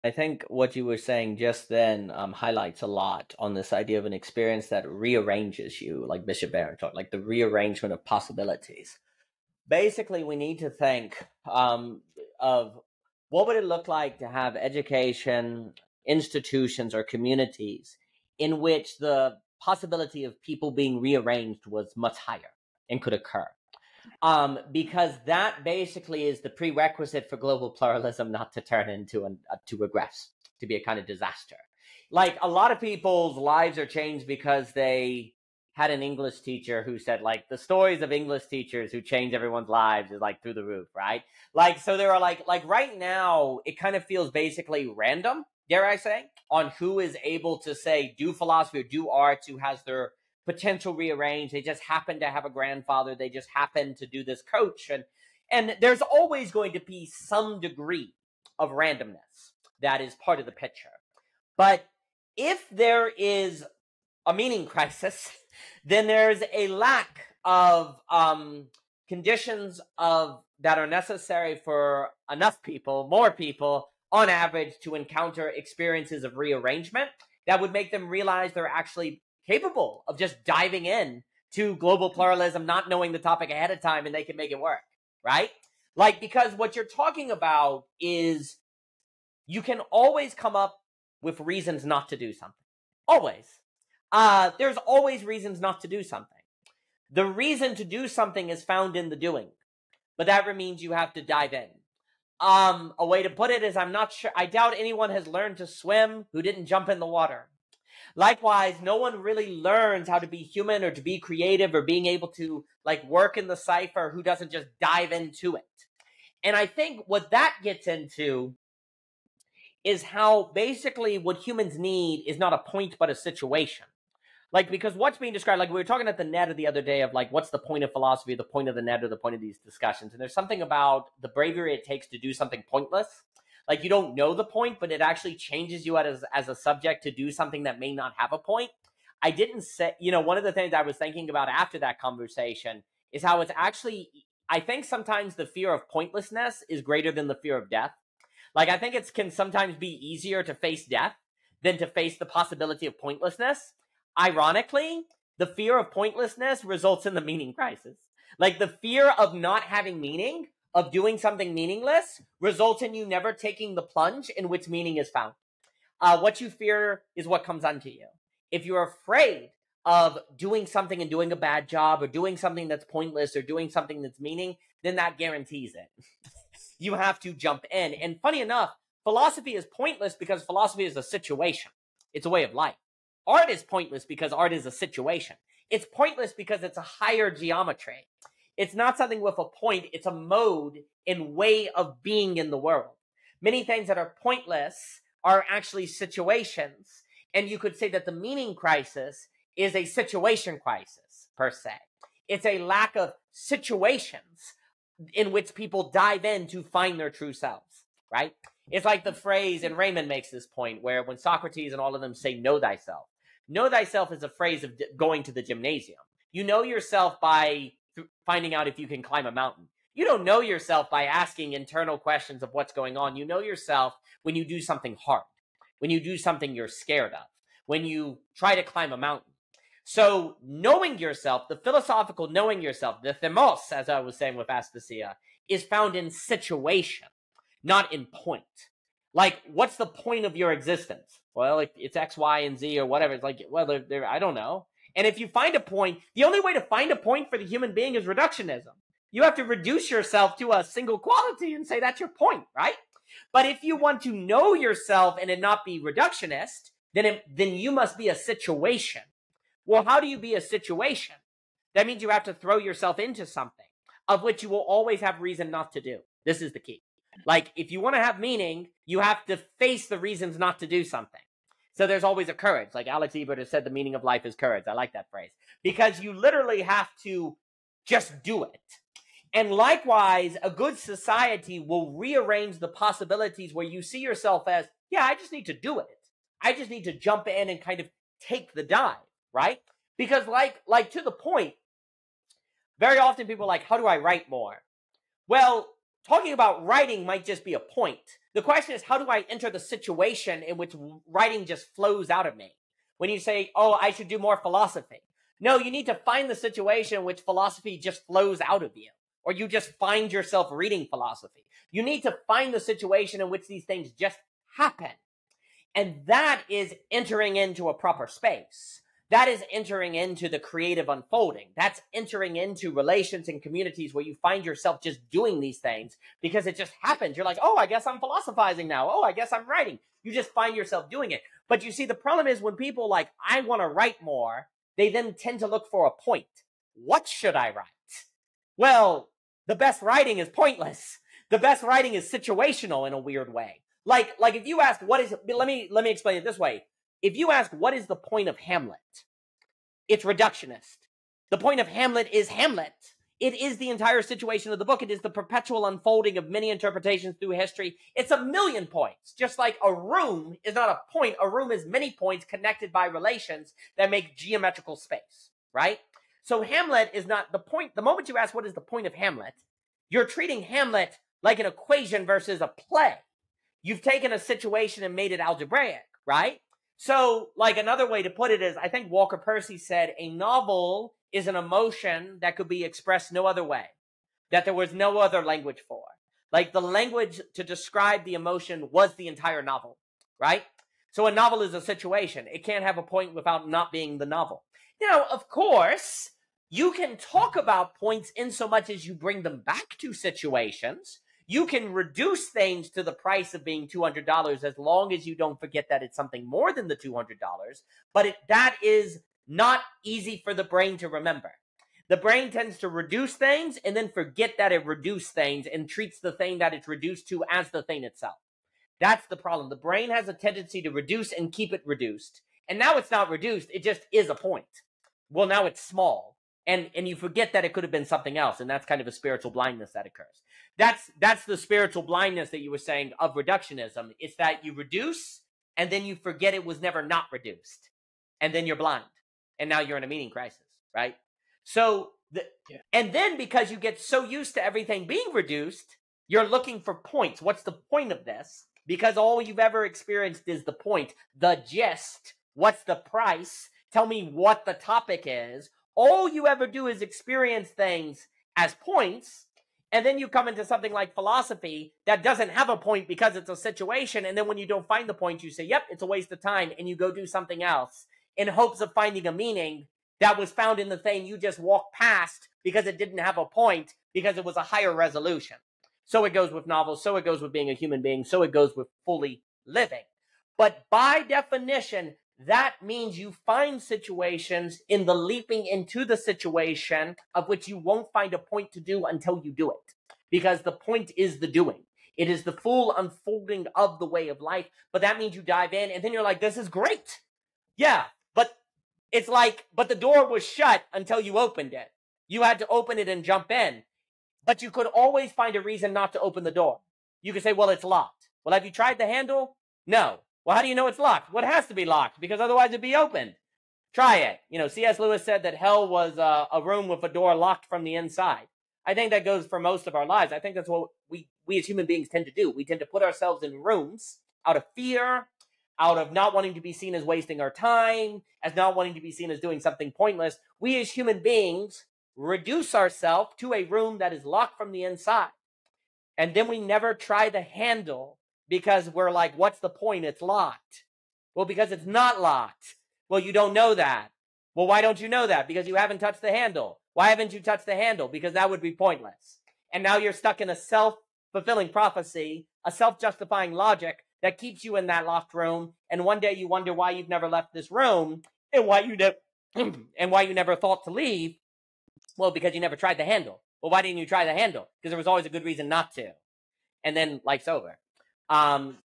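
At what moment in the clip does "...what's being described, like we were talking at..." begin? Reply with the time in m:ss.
2:04.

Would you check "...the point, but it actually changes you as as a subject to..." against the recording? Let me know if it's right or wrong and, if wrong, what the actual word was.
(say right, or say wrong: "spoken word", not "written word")
right.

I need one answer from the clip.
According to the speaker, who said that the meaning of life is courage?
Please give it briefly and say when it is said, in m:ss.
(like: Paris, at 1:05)
Alex Ebert, at 4:32.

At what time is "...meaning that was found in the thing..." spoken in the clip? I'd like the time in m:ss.
7:49.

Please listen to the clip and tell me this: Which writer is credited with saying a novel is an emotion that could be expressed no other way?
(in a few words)
Walker Percy.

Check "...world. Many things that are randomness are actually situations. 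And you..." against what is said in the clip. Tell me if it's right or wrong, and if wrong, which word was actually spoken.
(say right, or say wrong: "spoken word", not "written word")
wrong: "pointless", not "randomness".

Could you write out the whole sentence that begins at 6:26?
Like the language to describe the emotion was the entire novel, right?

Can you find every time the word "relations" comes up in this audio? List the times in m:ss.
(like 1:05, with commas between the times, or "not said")
5:22, 6:02.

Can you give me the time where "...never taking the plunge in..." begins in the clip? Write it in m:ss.
2:43.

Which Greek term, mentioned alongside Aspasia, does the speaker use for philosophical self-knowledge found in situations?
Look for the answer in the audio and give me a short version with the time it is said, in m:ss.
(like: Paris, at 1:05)
thumos, at 3:53.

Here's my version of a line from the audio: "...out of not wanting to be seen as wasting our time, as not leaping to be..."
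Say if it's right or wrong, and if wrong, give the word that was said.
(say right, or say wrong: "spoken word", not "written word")
wrong: "wanting", not "leaping".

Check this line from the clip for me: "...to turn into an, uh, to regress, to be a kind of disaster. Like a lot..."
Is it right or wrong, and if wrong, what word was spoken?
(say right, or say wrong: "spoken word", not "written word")
right.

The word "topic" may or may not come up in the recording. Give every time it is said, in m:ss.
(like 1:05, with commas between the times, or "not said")
1:23, 7:34.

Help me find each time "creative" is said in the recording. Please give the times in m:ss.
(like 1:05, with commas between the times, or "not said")
1:51, 5:20.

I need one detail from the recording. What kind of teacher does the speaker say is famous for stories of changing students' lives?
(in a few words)
English teacher.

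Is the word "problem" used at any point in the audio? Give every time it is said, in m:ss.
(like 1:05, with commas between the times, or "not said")
5:31, 6:59.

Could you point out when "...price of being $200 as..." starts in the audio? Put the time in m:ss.
6:42.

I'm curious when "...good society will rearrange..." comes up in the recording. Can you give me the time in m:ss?
4:40.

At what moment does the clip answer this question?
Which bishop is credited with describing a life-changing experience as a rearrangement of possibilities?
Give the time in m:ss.
0:06.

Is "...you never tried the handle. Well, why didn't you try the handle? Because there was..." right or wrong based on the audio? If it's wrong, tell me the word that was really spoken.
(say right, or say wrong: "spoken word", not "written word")
right.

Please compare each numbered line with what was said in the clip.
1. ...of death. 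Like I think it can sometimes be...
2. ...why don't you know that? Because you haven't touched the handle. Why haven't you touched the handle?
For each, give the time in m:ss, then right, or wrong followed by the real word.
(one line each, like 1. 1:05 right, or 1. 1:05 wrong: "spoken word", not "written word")
1. 2:27 right
2. 9:04 right.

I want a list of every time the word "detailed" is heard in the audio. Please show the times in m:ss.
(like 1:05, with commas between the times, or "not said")
not said.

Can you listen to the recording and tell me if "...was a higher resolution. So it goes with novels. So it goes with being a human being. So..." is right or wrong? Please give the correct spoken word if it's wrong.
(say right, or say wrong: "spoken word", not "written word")
right.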